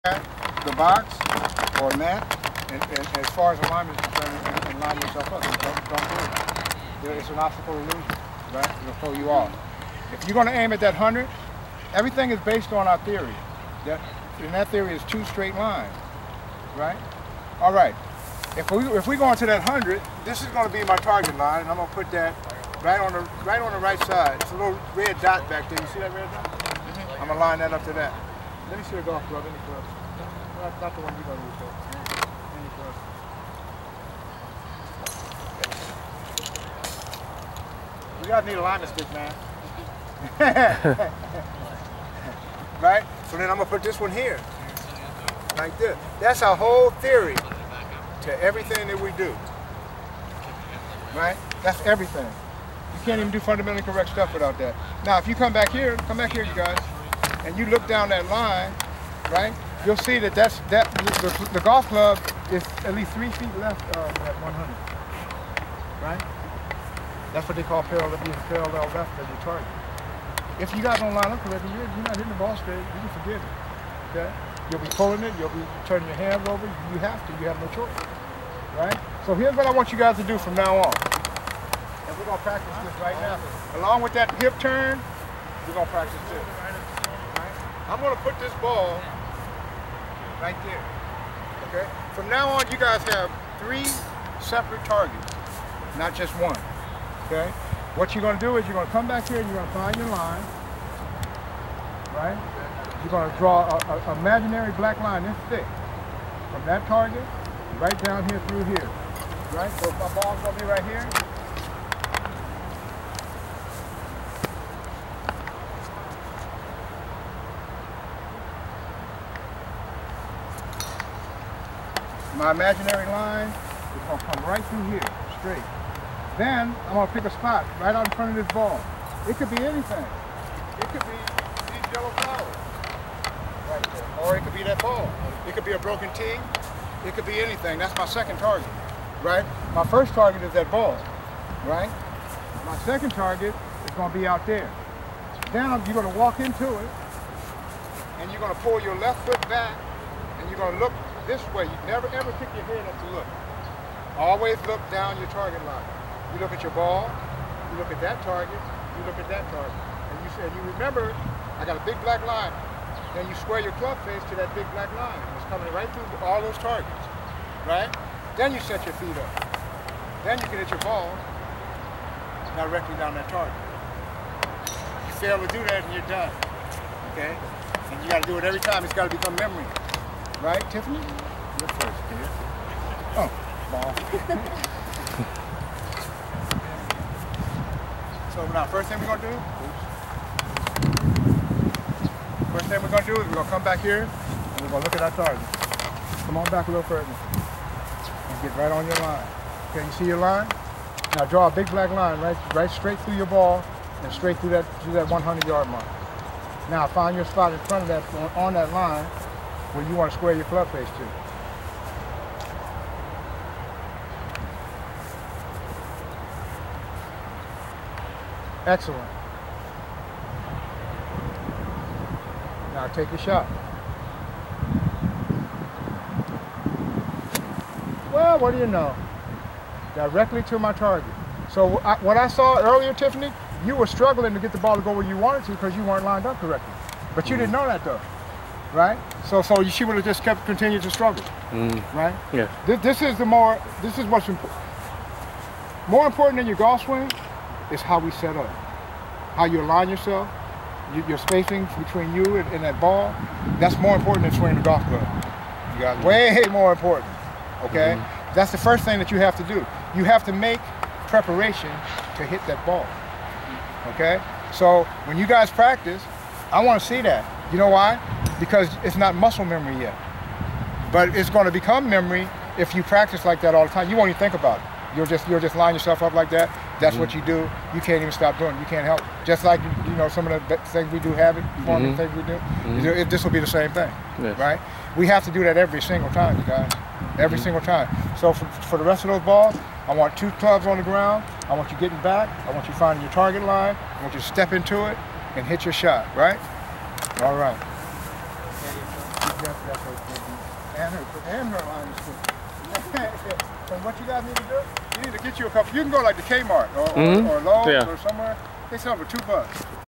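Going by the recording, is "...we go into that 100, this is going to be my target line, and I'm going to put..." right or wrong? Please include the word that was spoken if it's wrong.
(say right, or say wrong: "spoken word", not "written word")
right.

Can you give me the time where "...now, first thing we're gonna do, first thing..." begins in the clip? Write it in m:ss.
3:08.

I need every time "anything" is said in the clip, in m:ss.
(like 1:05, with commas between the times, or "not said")
2:09, 2:17.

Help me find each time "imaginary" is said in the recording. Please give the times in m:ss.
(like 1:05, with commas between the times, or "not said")
1:44, 2:02.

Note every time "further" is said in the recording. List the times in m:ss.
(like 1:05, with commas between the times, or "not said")
3:16.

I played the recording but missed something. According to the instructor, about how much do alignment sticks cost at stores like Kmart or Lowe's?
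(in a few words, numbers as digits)
2 bucks.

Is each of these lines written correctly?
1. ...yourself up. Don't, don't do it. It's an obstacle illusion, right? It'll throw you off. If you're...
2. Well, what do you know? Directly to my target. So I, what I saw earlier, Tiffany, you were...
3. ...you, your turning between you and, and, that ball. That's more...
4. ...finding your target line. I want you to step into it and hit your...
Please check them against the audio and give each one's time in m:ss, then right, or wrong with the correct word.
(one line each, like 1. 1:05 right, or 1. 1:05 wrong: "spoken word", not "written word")
1. 0:05 right
2. 3:48 right
3. 4:10 wrong: "spacing", not "turning"
4. 4:52 right.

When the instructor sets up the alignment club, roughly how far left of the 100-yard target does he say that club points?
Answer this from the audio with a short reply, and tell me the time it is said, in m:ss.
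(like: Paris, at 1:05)
3 feet, at 1:03.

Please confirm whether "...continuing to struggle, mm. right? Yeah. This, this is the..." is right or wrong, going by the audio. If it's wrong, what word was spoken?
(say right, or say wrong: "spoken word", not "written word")
right.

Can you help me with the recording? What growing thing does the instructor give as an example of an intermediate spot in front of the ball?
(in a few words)
yellow flowers.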